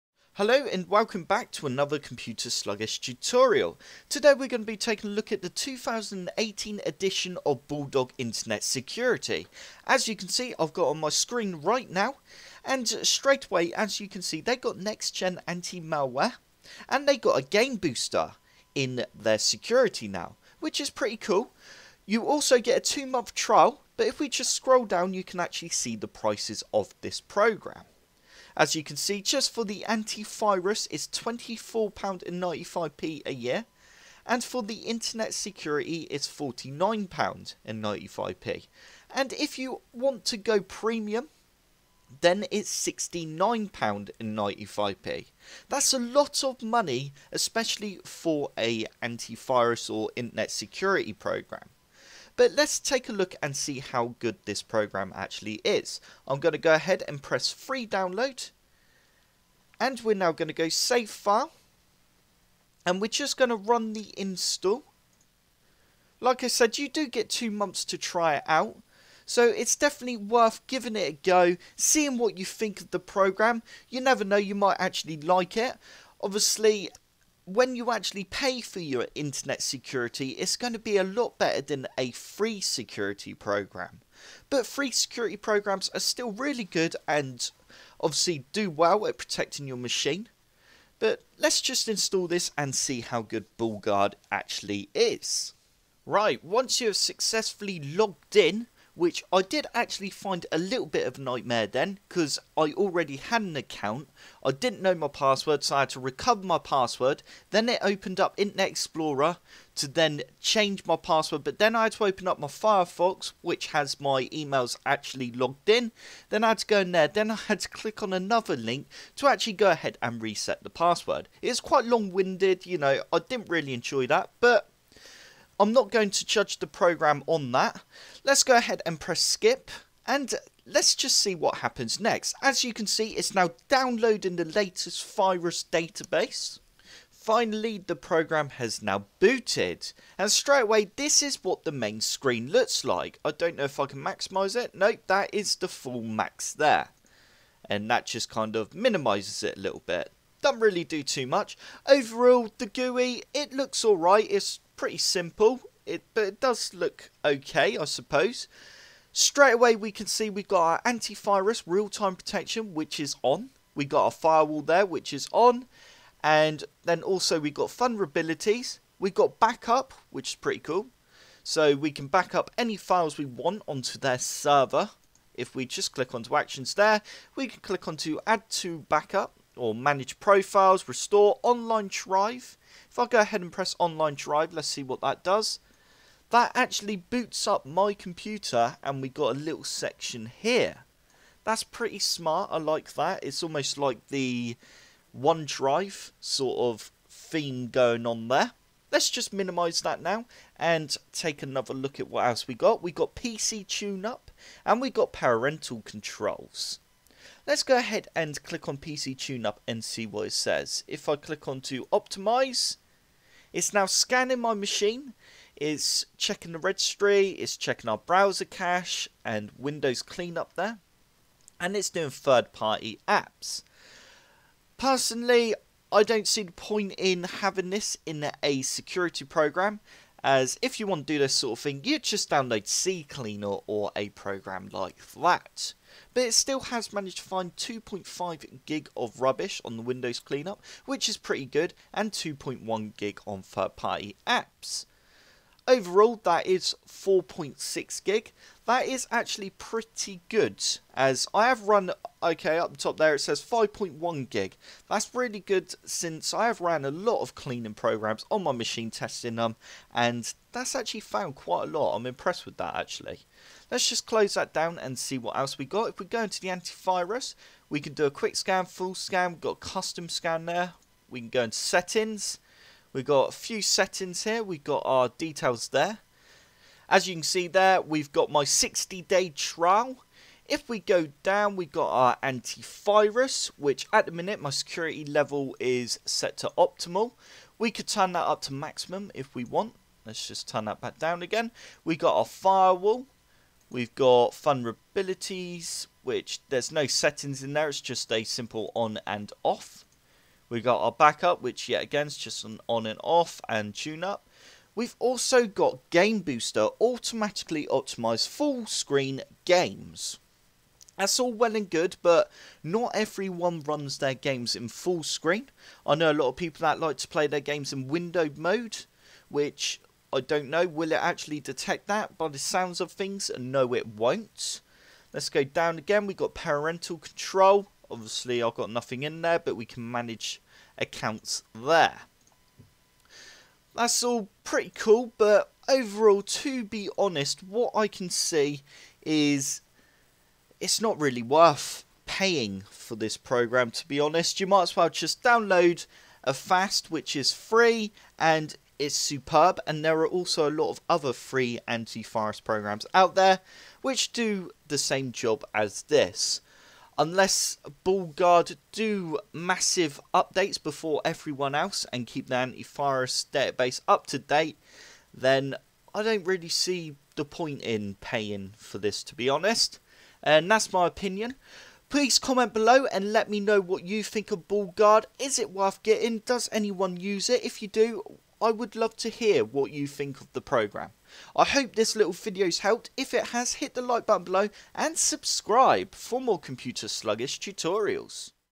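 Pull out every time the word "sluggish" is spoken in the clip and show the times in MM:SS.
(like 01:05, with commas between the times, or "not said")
00:02, 06:26.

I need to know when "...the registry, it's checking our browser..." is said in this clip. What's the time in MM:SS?
03:36.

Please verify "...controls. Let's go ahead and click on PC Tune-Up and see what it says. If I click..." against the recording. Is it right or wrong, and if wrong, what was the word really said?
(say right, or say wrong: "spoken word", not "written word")
right.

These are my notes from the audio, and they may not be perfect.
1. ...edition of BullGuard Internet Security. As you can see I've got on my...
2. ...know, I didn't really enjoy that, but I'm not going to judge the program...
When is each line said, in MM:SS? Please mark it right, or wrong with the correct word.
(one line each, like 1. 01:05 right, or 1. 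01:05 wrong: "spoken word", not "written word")
1. 00:06 right
2. 02:02 right.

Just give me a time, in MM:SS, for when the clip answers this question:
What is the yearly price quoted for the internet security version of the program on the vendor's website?
00:36.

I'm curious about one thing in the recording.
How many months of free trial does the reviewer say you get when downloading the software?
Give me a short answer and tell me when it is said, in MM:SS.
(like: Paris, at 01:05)
2 months, at 00:22.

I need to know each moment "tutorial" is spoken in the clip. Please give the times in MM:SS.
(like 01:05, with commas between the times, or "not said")
00:02, 06:27.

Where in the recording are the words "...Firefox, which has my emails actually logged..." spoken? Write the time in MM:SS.
01:52.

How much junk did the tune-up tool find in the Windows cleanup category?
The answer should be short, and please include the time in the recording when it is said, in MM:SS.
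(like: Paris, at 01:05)
2.5 gig, at 03:57.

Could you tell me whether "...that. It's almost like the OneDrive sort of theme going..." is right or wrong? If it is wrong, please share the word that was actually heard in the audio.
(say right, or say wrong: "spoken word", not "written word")
right.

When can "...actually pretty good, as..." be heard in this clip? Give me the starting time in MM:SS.
04:09.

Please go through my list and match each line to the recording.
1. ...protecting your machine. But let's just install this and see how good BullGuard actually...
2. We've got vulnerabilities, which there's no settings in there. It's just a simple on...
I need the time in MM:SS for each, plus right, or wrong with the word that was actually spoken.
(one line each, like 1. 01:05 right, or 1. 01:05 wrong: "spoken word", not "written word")
1. 01:29 right
2. 04:53 right.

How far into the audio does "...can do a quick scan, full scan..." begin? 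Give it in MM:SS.
04:27.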